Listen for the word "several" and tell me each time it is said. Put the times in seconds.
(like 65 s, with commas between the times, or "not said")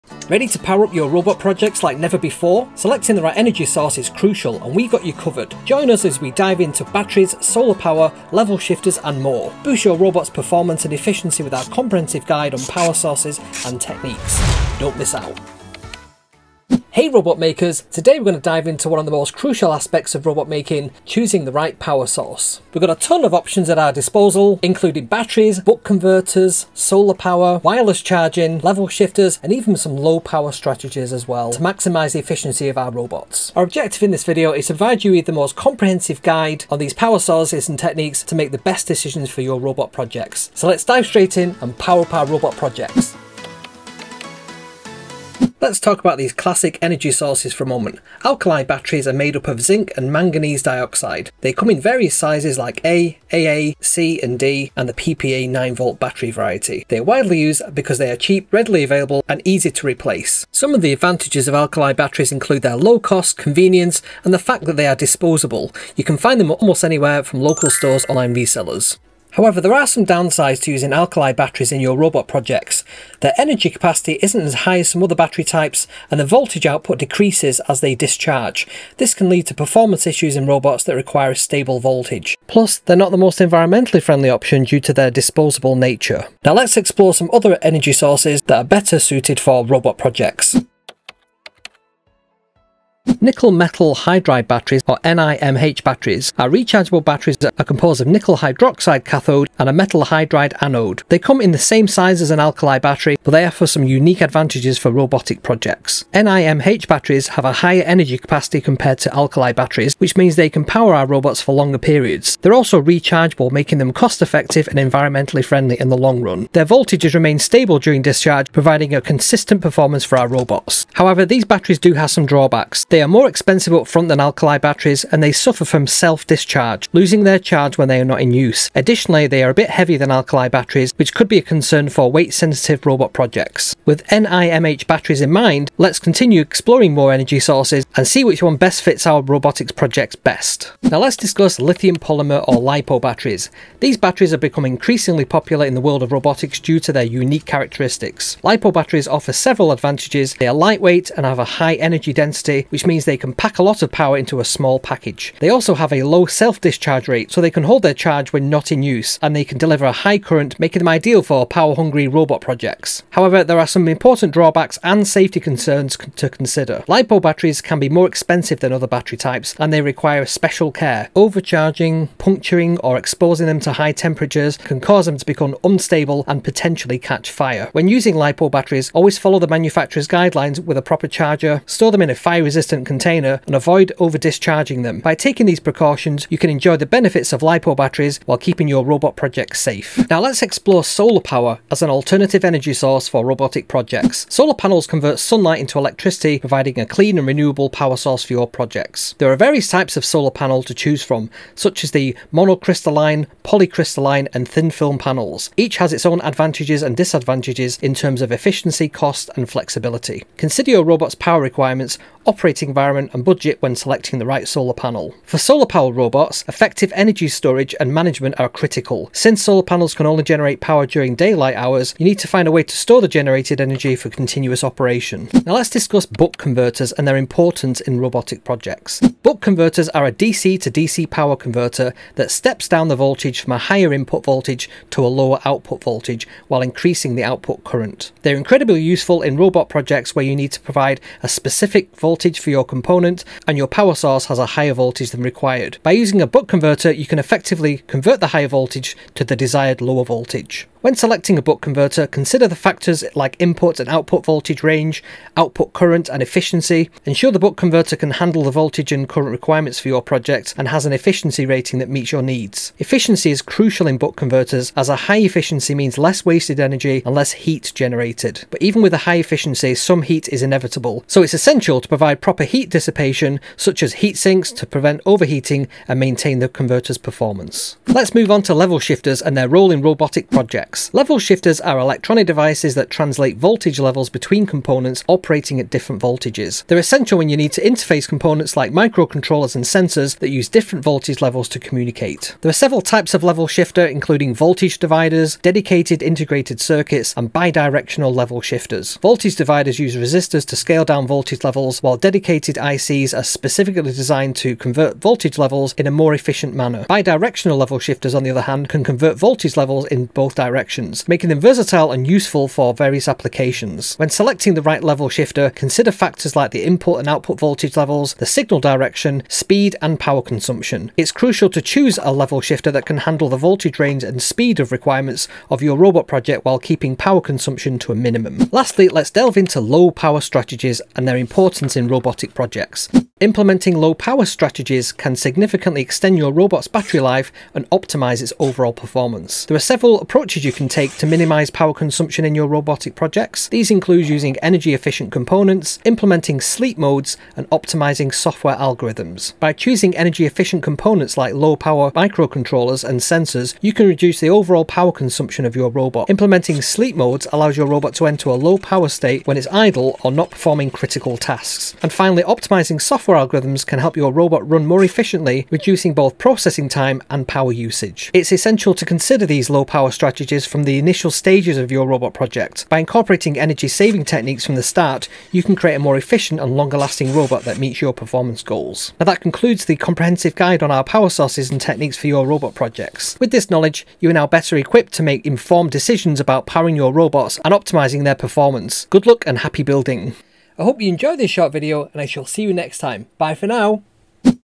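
149 s, 292 s, 339 s.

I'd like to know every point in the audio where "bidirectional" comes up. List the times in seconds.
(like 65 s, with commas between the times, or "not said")
297 s, 306 s.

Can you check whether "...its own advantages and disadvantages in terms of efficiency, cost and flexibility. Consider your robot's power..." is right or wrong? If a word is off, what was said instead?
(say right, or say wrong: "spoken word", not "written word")
right.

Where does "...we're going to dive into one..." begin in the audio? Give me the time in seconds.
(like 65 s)
18 s.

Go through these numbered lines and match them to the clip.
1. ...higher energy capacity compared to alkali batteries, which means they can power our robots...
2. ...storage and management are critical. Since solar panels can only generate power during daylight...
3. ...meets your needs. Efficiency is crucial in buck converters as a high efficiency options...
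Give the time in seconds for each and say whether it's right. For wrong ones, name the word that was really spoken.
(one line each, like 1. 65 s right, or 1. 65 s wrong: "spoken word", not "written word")
1. 107 s right
2. 217 s right
3. 261 s wrong: "means", not "options".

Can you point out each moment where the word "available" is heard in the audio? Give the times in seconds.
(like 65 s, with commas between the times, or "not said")
58 s.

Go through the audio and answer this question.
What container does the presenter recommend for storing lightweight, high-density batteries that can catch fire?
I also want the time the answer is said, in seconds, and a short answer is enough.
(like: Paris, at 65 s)
Fire-resistant container, at 182 s.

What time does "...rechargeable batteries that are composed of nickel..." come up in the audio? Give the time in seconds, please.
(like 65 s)
96 s.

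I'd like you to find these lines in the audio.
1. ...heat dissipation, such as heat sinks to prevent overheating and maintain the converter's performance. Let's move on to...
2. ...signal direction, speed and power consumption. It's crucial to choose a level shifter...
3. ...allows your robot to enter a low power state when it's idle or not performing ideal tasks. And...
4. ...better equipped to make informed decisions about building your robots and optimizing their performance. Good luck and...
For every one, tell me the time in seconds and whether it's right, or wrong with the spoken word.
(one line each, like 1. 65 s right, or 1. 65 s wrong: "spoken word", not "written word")
1. 272 s right
2. 318 s right
3. 357 s wrong: "critical", not "ideal"
4. 384 s wrong: "powering", not "building".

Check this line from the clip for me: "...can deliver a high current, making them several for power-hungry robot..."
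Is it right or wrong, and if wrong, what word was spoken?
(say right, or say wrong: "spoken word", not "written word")
wrong: "ideal", not "several".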